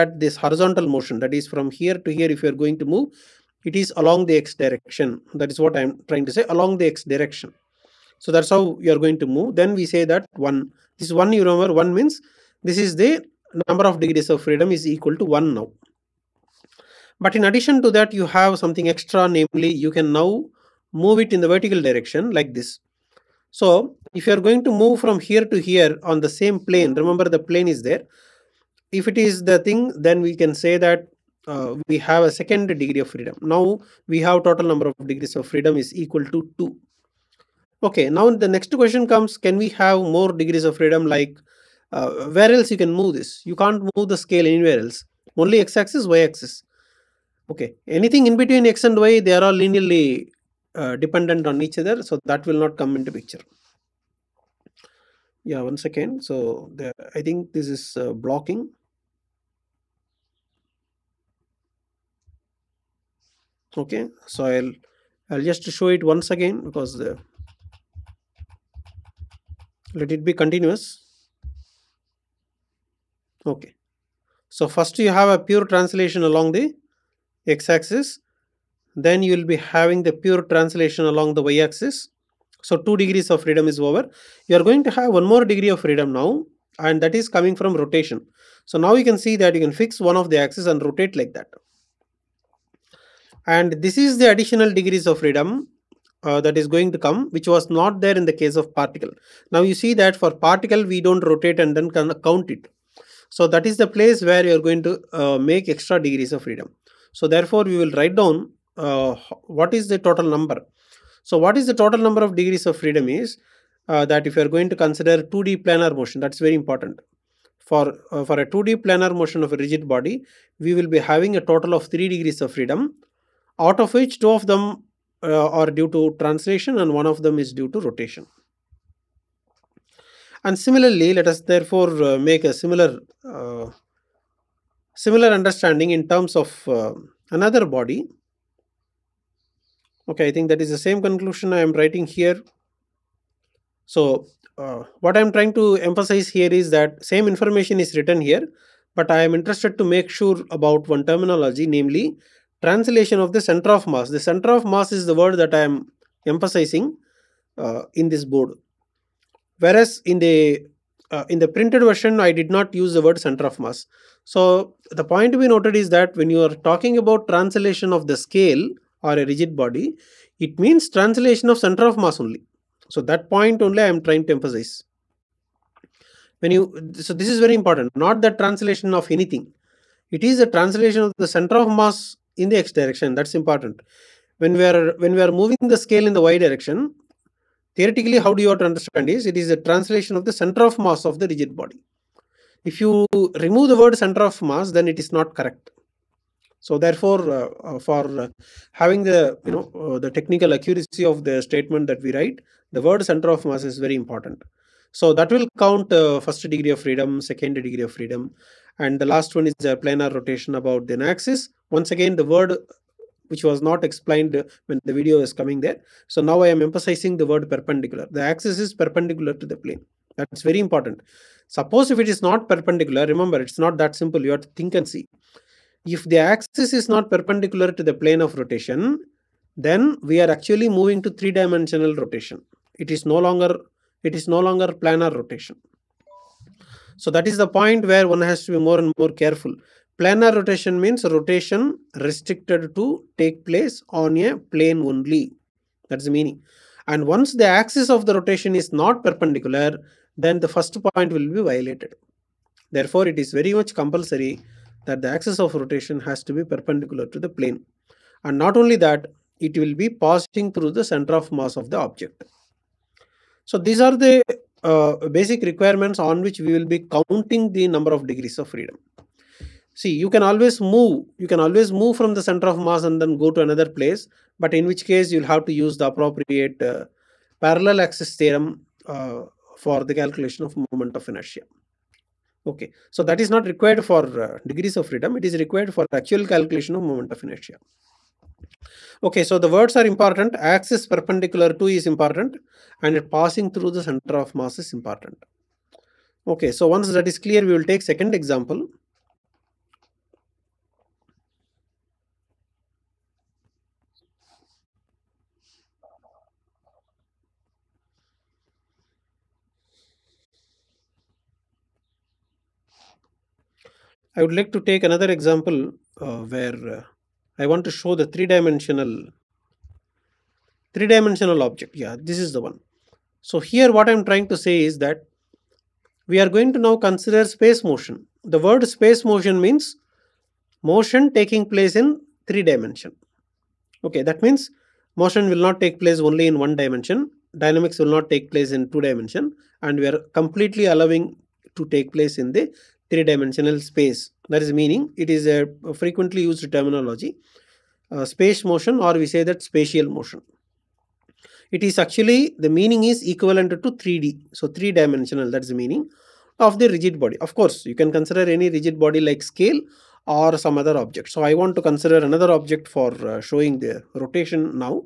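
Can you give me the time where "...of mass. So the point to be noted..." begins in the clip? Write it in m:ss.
2:43.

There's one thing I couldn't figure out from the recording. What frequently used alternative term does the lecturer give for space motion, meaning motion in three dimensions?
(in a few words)
spatial motion.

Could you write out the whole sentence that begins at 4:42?
Okay, so that is not required for uh, degrees of freedom.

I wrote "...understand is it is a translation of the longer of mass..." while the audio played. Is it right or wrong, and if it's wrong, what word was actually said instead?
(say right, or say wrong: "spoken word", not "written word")
wrong: "center", not "longer".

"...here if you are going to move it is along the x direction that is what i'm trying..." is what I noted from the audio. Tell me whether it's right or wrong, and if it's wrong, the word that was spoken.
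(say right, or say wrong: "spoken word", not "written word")
right.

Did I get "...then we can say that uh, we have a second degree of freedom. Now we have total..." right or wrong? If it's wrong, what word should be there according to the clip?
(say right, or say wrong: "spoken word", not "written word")
right.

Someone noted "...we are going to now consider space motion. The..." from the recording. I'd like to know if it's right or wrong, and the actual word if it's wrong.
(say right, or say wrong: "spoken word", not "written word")
right.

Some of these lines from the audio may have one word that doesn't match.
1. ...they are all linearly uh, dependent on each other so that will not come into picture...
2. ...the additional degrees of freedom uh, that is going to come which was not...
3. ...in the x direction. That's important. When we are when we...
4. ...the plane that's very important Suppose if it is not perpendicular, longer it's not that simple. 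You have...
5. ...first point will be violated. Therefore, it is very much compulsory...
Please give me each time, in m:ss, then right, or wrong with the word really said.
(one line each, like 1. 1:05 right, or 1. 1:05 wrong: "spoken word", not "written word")
1. 0:49 right
2. 1:34 right
3. 3:02 right
4. 3:39 wrong: "remember", not "longer"
5. 4:10 right.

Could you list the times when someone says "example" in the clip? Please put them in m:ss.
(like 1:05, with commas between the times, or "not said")
4:58, 5:15.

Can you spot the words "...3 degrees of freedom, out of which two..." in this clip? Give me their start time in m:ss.
2:01.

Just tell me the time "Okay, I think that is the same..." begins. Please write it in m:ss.
2:20.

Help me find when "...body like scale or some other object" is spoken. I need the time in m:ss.
5:58.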